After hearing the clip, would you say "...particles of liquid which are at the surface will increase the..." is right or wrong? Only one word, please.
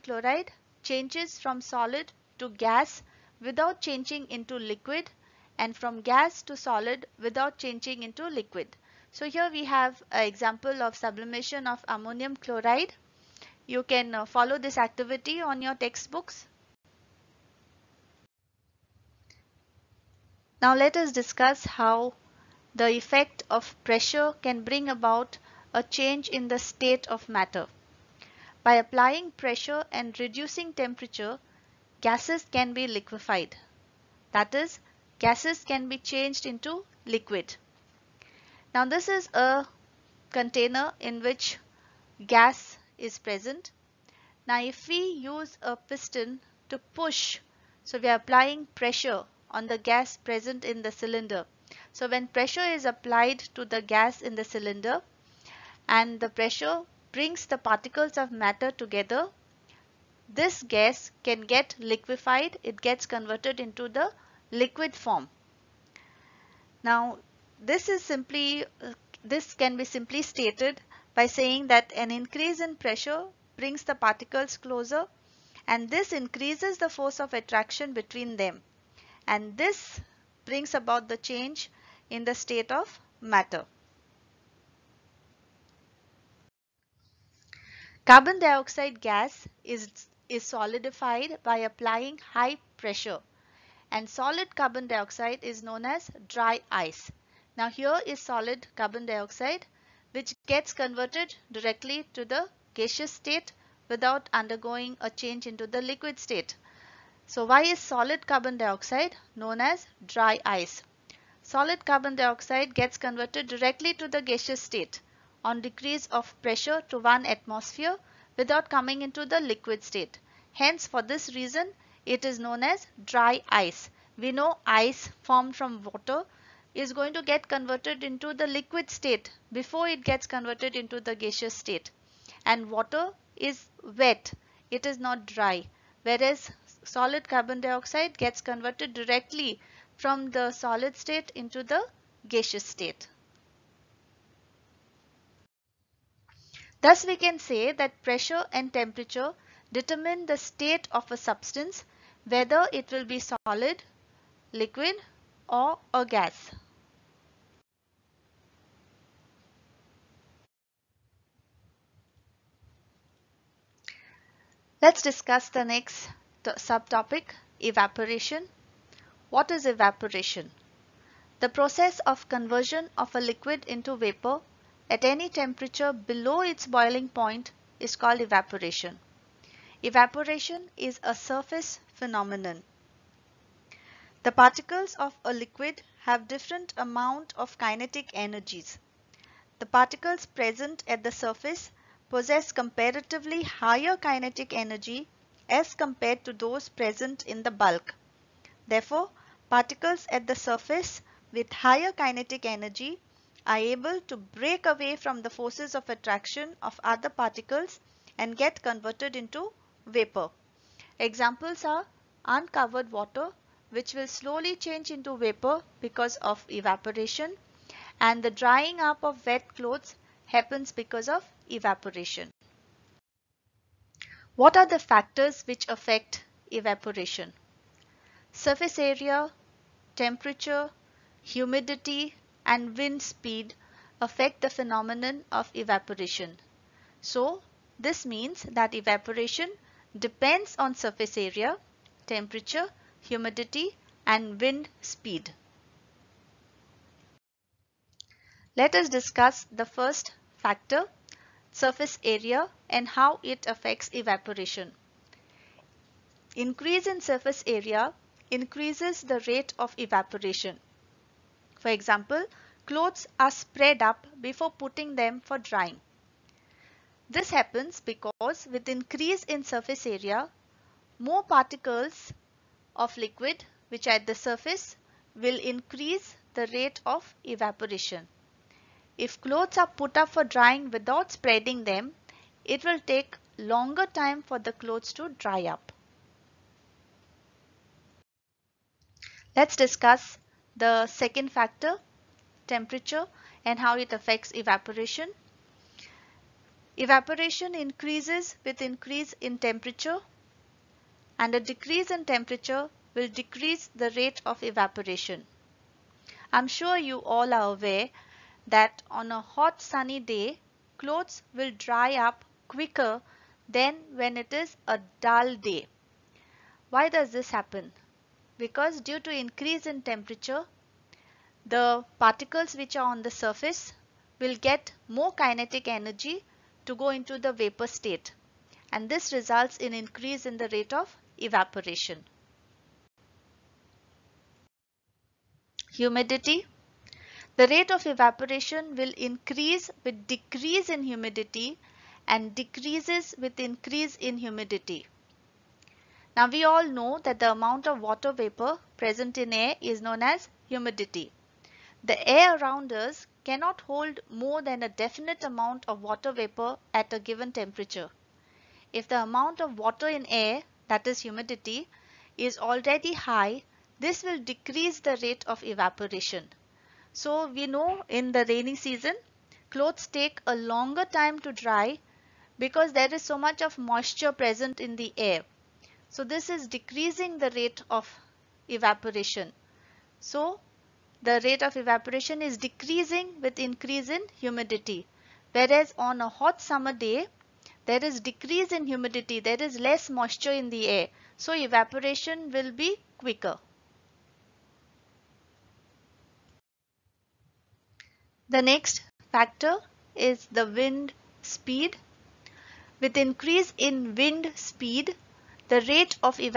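right.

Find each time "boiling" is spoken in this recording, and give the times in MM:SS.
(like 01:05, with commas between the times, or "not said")
02:56.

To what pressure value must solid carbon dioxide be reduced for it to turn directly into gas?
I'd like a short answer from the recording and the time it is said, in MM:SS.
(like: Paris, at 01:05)
1 atmosphere, at 01:56.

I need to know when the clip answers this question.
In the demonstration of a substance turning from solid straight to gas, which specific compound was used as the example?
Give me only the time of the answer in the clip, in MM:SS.
00:11.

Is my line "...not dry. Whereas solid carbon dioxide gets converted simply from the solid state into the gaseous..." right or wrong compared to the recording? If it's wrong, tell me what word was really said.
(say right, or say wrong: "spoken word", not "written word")
wrong: "directly", not "simply".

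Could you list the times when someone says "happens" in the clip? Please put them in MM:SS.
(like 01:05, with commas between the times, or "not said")
03:40, 04:27, 05:17.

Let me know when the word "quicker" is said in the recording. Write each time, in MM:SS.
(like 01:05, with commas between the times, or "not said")
05:12, 06:32.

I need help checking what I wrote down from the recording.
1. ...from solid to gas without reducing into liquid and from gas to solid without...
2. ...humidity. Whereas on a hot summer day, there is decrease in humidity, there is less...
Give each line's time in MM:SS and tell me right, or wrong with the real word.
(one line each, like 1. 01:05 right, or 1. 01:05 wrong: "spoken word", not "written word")
1. 00:01 wrong: "changing", not "reducing"
2. 06:24 right.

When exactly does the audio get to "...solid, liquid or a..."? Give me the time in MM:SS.
02:33.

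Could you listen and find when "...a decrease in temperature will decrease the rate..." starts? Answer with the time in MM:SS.
05:01.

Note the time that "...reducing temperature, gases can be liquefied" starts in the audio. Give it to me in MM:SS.
00:30.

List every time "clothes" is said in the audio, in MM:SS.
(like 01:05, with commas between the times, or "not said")
03:39, 04:22, 04:39, 04:44, 05:10, 06:09.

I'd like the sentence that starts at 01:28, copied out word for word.
Carbon dioxide gas is, is solidified by applying high pressure and solid carbon dioxide is known as dry ice.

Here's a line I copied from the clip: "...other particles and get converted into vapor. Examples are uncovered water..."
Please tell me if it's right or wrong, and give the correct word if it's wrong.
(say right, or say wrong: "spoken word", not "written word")
right.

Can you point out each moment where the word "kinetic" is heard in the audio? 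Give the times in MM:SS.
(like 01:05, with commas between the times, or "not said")
03:07, 03:13, 03:21, 05:25.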